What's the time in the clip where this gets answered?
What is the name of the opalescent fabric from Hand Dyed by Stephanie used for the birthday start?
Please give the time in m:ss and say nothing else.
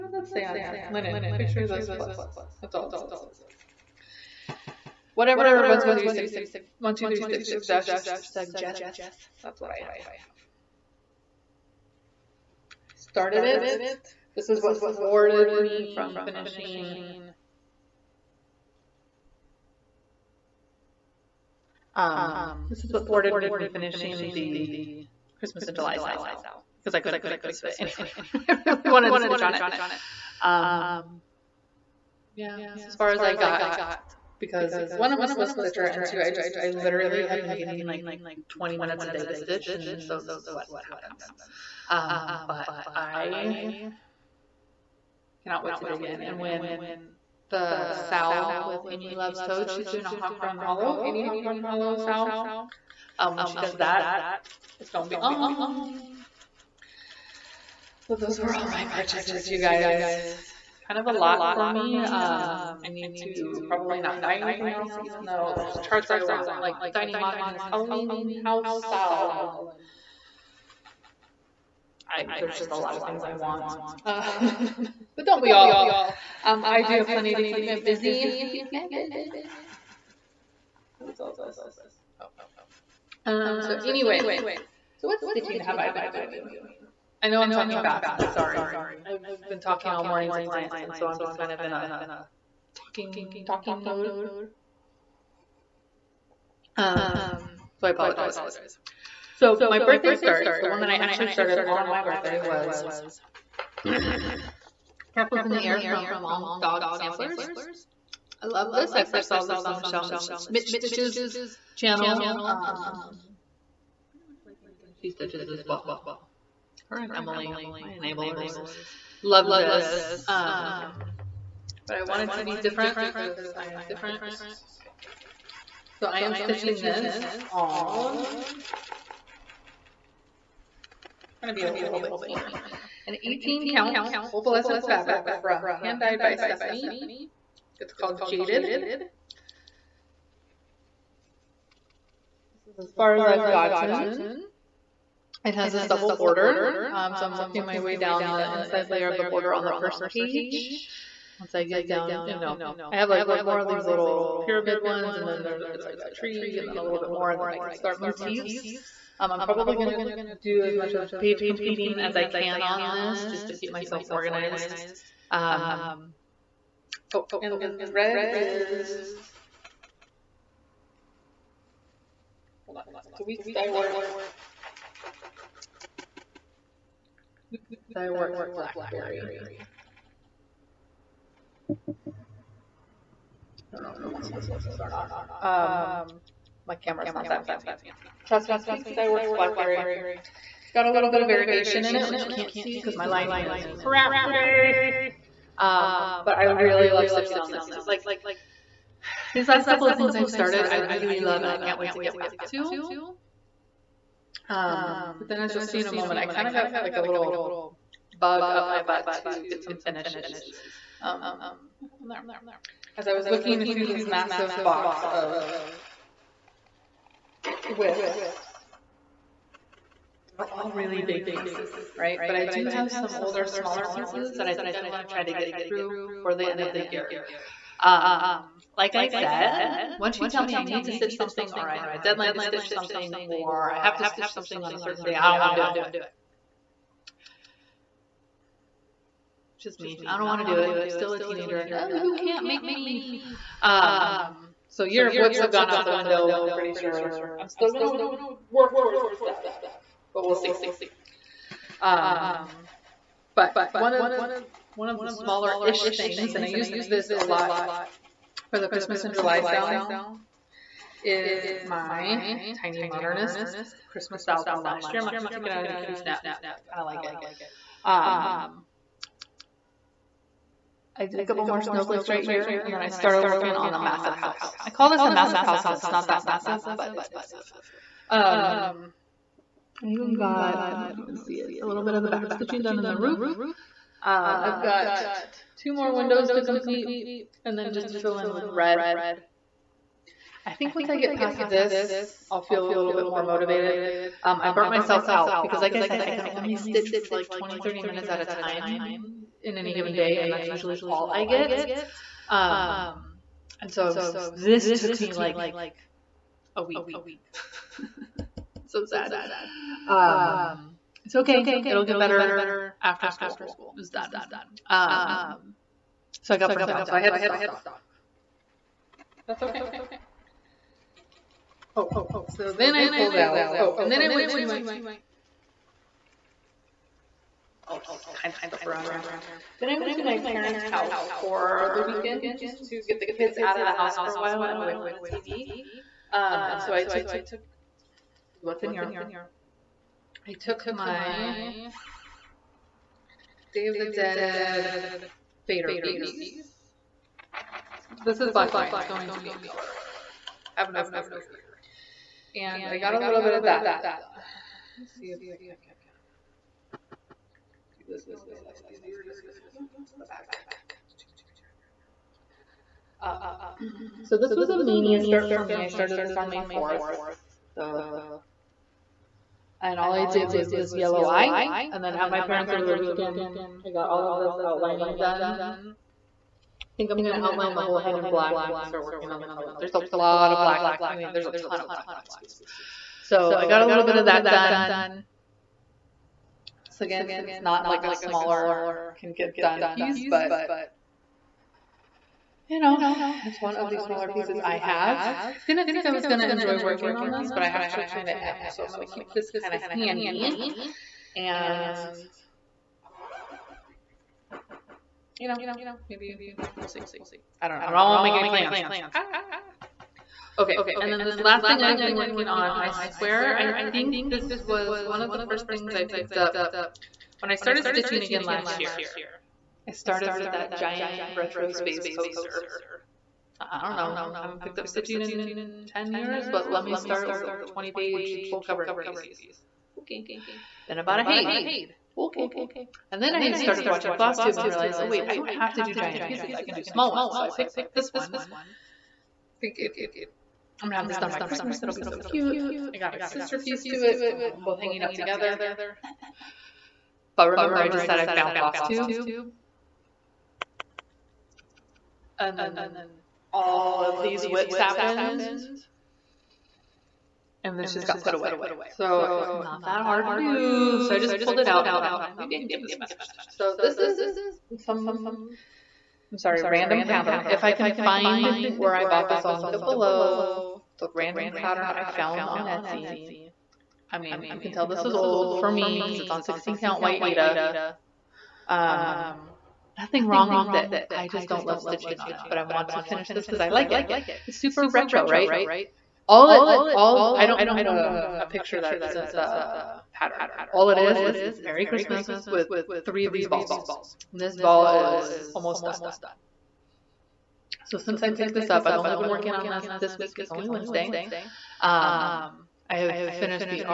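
2:18.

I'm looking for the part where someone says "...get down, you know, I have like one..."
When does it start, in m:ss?
2:31.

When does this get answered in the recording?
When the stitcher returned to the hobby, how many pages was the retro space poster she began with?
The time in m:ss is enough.
7:07.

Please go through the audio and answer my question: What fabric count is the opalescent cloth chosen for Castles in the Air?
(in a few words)
18.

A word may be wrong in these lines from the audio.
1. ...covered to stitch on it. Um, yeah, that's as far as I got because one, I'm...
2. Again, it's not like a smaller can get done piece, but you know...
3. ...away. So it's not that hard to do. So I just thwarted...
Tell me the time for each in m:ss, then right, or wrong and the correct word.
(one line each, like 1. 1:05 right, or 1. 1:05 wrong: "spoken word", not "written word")
1. 0:28 wrong: "wanted", not "covered"
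2. 6:26 right
3. 7:38 wrong: "pulled", not "thwarted".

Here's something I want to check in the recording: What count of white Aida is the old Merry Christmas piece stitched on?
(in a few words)
16.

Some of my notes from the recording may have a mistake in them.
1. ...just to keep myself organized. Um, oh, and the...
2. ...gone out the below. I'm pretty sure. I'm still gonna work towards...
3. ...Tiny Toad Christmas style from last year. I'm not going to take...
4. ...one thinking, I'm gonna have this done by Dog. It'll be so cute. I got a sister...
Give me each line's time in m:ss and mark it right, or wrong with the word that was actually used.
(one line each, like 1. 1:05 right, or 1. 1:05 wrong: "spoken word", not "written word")
1. 2:43 right
2. 4:05 wrong: "window", not "below"
3. 4:22 wrong: "Modernist", not "Toad"
4. 7:17 wrong: "Christmas", not "Dog".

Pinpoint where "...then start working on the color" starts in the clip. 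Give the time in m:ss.
6:18.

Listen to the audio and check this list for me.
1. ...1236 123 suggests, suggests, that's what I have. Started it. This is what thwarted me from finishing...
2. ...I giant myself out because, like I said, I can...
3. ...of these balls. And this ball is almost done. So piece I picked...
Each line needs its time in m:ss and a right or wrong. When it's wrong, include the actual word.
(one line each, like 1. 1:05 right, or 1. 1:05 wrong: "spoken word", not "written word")
1. 0:05 right
2. 4:54 wrong: "burnt", not "giant"
3. 8:13 wrong: "since", not "piece".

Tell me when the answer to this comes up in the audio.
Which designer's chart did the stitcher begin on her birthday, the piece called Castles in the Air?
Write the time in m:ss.
1:46.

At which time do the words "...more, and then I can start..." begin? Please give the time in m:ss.
2:37.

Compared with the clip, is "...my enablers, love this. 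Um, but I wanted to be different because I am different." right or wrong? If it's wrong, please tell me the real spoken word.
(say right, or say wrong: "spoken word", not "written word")
right.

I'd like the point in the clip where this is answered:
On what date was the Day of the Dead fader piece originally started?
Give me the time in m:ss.
6:06.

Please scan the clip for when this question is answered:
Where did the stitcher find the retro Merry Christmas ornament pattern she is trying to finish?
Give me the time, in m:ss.
7:52.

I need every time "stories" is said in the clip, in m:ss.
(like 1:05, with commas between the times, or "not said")
not said.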